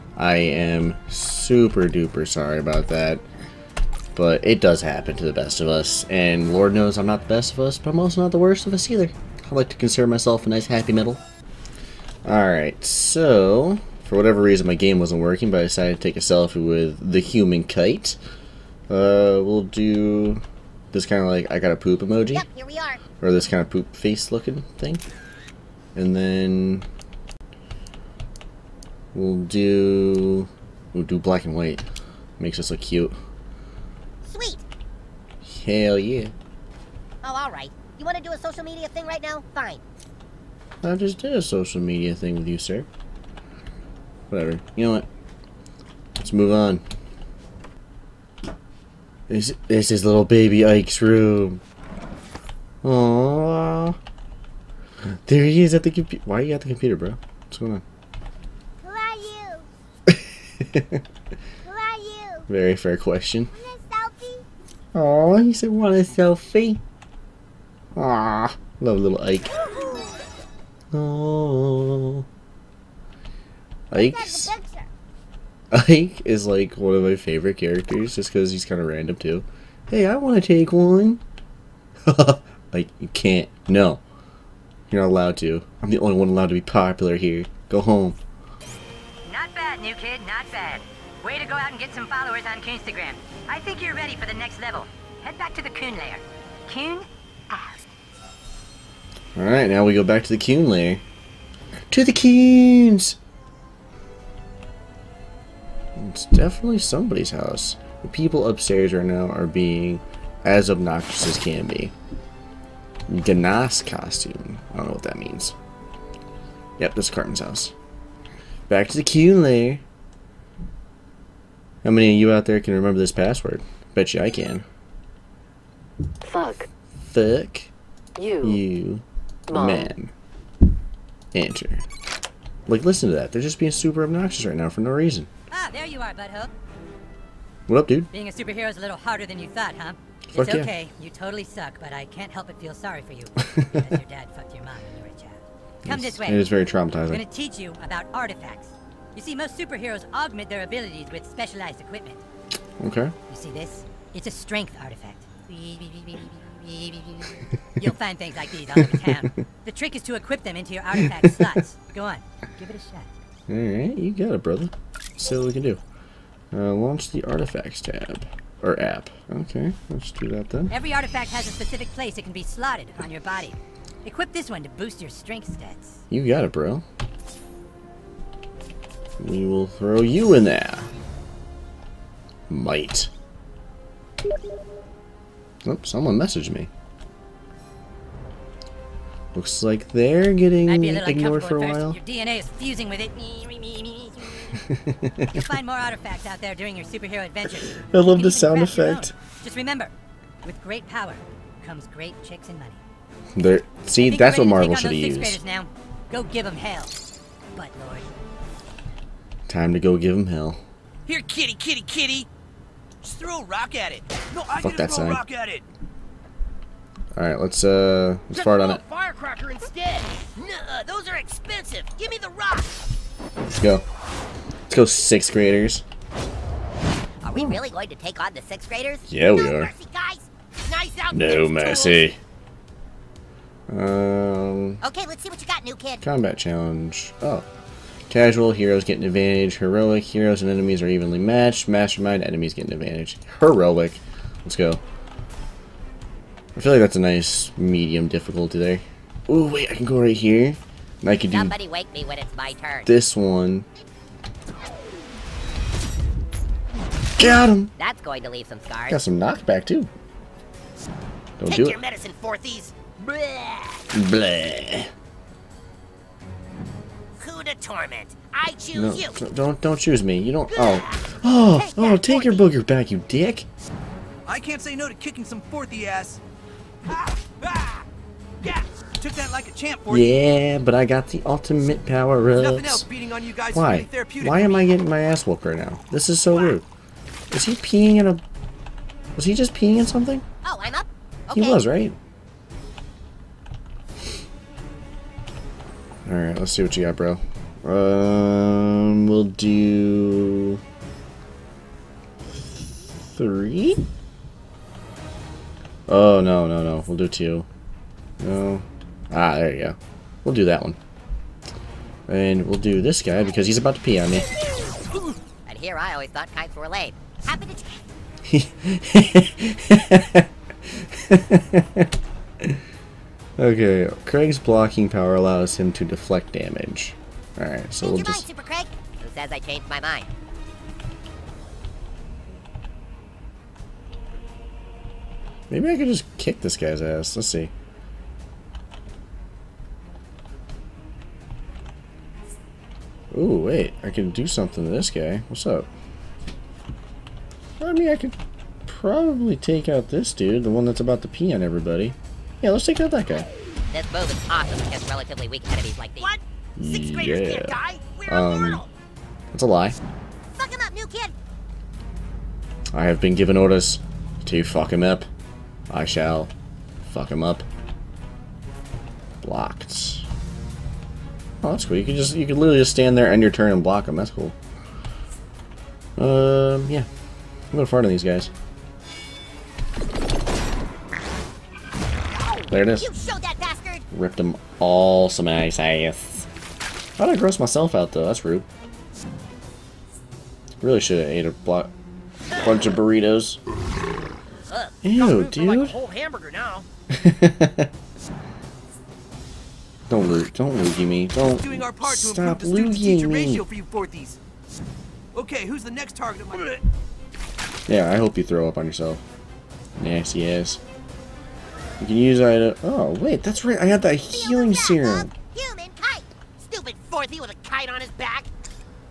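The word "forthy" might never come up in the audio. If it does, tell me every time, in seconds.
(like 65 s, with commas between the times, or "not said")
275 s, 416 s.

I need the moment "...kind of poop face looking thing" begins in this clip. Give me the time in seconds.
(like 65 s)
23 s.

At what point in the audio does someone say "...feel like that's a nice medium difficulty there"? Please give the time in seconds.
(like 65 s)
246 s.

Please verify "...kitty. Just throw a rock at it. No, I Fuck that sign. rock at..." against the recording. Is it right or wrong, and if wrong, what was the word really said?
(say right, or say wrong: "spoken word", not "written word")
right.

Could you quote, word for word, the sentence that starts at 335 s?
Maybe I could just kick this guy's ass.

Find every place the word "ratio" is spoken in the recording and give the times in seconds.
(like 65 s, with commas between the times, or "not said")
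403 s.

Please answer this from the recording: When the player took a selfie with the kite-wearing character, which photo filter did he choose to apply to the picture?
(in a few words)
Black and white.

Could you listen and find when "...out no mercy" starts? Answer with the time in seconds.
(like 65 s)
230 s.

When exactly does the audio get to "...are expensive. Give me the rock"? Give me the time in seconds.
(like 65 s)
221 s.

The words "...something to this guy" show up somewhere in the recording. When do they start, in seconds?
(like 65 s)
344 s.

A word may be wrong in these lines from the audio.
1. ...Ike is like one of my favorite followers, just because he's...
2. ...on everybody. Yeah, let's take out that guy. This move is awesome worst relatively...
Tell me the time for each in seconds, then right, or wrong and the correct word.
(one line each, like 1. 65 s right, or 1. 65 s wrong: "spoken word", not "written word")
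1. 73 s wrong: "characters", not "followers"
2. 351 s wrong: "against", not "worst".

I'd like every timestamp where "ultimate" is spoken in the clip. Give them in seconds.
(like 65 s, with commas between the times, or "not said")
281 s.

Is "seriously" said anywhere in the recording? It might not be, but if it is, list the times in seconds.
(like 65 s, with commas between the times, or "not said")
not said.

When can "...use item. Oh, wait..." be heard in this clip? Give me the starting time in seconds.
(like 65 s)
411 s.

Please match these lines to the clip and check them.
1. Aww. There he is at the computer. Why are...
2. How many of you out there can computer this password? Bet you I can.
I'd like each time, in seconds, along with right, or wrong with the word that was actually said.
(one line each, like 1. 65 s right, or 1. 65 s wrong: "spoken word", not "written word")
1. 52 s right
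2. 121 s wrong: "remember", not "computer".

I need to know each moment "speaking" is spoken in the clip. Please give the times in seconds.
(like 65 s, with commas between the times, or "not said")
not said.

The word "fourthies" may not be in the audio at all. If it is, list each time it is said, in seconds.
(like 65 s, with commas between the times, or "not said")
262 s, 403 s.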